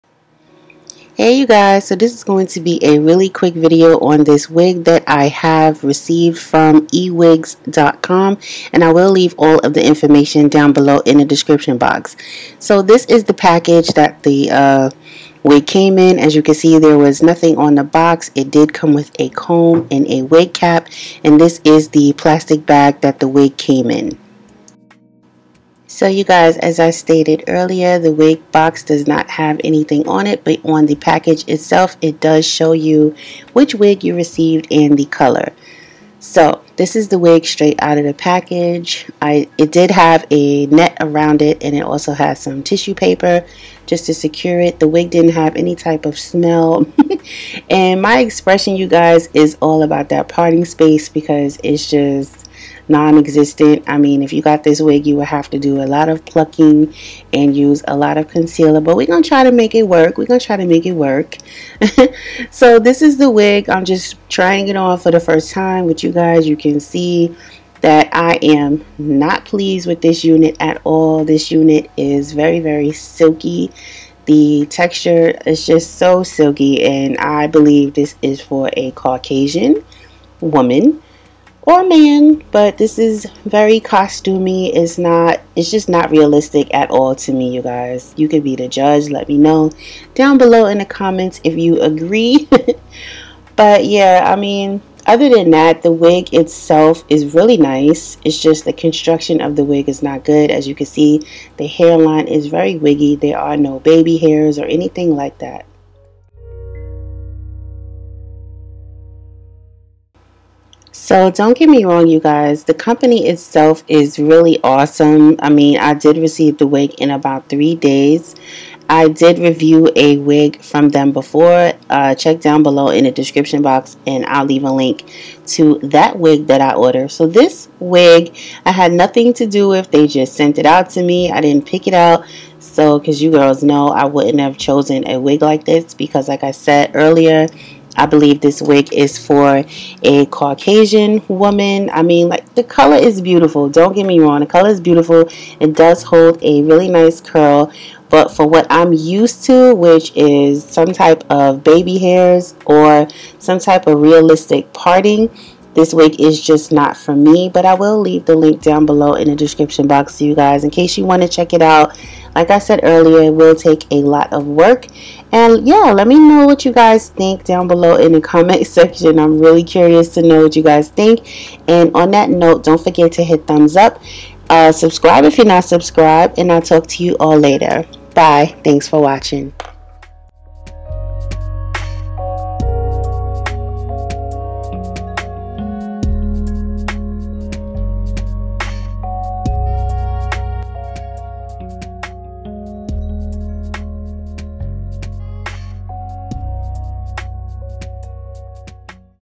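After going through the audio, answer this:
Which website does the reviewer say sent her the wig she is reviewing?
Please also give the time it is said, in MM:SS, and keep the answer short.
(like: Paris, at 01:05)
ewigs.com, at 00:06.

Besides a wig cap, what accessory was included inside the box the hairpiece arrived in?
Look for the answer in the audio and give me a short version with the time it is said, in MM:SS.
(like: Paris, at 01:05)
A comb, at 00:19.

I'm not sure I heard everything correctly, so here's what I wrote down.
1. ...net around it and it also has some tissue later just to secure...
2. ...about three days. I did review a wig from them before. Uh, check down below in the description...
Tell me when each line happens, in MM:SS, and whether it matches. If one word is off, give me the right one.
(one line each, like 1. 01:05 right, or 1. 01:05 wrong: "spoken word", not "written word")
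1. 00:40 wrong: "paper", not "later"
2. 01:57 right.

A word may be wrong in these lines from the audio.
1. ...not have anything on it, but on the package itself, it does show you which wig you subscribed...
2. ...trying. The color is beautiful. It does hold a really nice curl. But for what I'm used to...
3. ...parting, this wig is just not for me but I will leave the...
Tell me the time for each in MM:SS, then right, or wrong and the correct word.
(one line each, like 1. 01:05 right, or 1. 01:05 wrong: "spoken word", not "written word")
1. 00:29 wrong: "received", not "subscribed"
2. 02:24 wrong: "wrong", not "trying"
3. 02:34 right.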